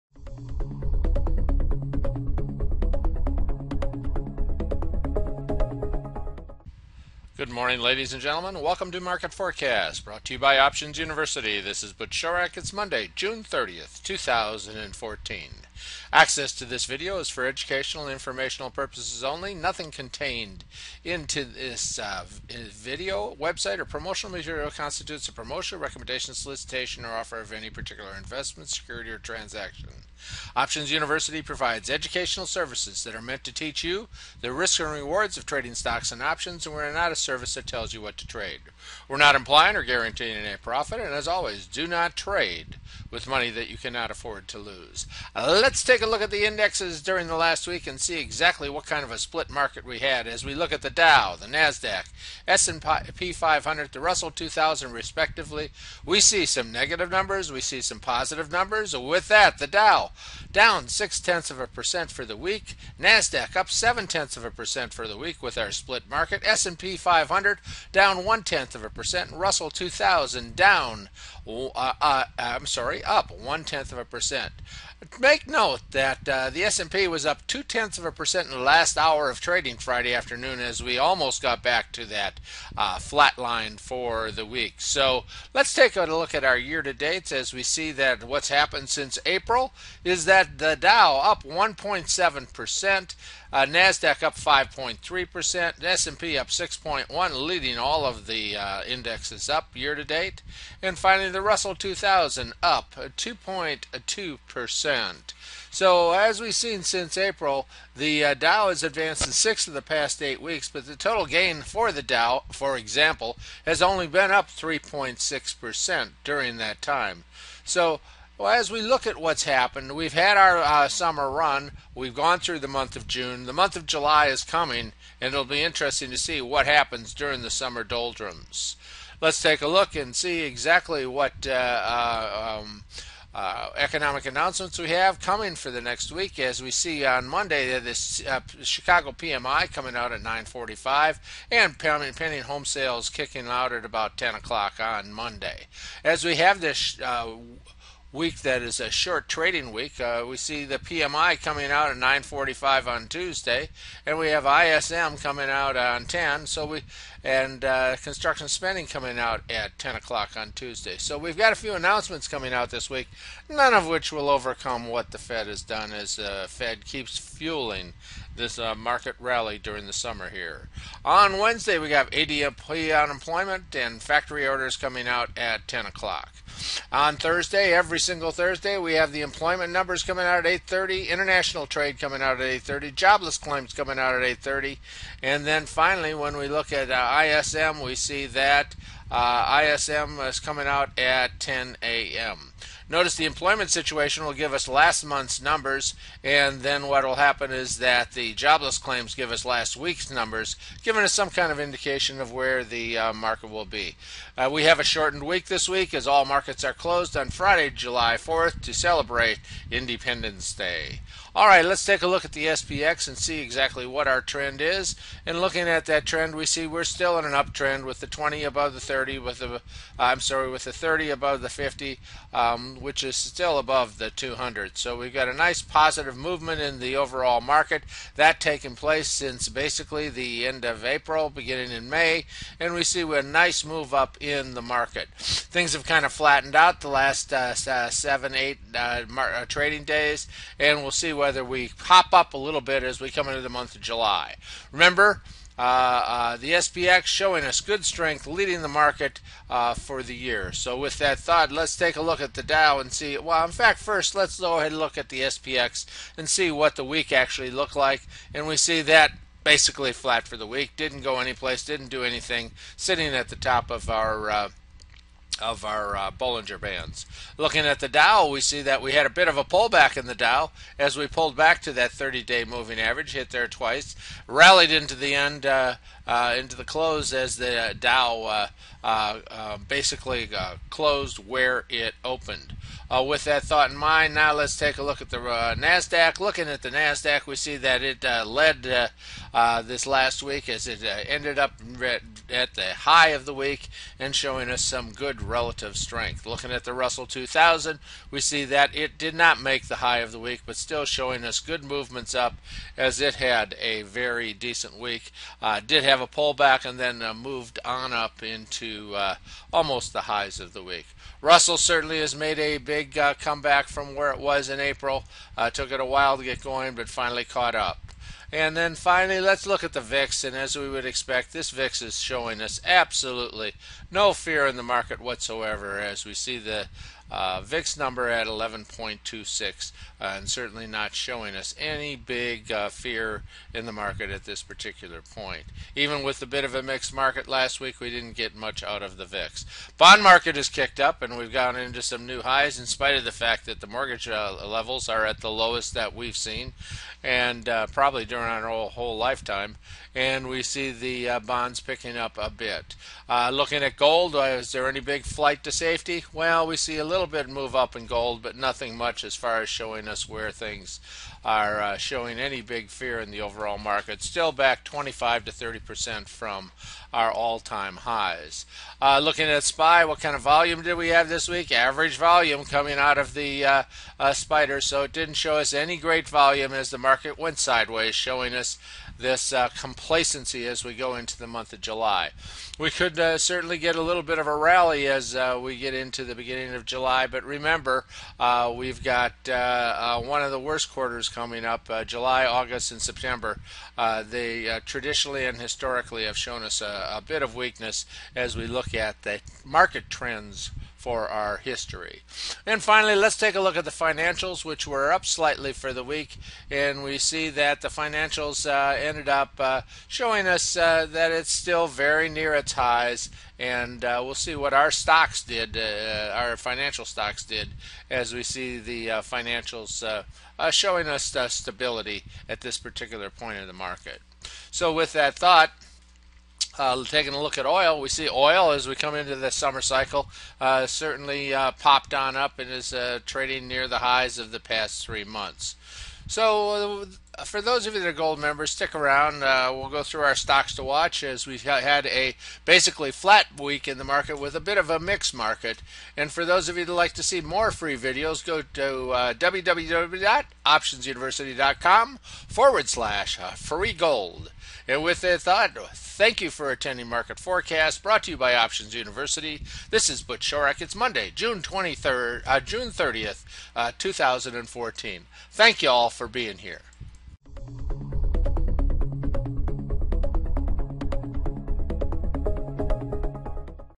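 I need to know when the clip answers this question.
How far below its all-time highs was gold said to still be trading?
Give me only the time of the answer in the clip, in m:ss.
6:04.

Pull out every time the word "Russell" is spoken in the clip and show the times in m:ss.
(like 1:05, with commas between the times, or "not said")
0:54, 1:09, 1:41, 4:56, 5:11.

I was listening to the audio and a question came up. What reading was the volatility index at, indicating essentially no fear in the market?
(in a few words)
11.26.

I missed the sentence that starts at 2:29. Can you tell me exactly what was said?
Uh, we see the PMI coming out at 9:45 on Tuesday, and we have ISM coming out on 10.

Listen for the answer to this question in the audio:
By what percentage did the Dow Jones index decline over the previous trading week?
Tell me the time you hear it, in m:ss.
1:00.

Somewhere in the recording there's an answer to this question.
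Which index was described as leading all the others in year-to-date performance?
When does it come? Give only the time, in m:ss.
1:35.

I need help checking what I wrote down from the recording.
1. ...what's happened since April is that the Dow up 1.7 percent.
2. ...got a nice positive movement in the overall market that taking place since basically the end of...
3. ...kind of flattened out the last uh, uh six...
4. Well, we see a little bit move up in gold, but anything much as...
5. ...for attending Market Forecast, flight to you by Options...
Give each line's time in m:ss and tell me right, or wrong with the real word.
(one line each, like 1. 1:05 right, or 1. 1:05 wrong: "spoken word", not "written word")
1. 1:28 right
2. 3:45 right
3. 3:55 wrong: "seven", not "six"
4. 5:56 wrong: "nothing", not "anything"
5. 7:36 wrong: "brought", not "flight".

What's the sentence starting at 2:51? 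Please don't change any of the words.
On Wednesday, we have ADP unemployment and factory orders coming out at 10 o'clock.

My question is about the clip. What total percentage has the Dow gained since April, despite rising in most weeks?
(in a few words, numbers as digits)
3.6%.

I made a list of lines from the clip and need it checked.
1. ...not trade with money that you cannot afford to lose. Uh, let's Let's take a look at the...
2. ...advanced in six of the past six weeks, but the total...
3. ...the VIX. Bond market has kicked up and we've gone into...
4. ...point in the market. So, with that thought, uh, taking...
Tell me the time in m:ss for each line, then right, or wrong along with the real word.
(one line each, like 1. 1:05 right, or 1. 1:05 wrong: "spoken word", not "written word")
1. 0:41 right
2. 1:48 wrong: "eight", not "six"
3. 5:38 right
4. 7:03 right.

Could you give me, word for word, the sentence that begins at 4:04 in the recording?
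Remember, uh, uh, the SPX showing us good strength, leading the market uh, for the year.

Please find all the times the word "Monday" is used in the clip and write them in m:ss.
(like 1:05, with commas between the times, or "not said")
0:12, 2:17, 2:25, 7:40.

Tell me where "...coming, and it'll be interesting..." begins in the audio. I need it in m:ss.
2:04.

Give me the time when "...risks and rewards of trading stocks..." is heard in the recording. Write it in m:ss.
0:34.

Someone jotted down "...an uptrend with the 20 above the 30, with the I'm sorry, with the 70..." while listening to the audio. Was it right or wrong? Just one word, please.
wrong.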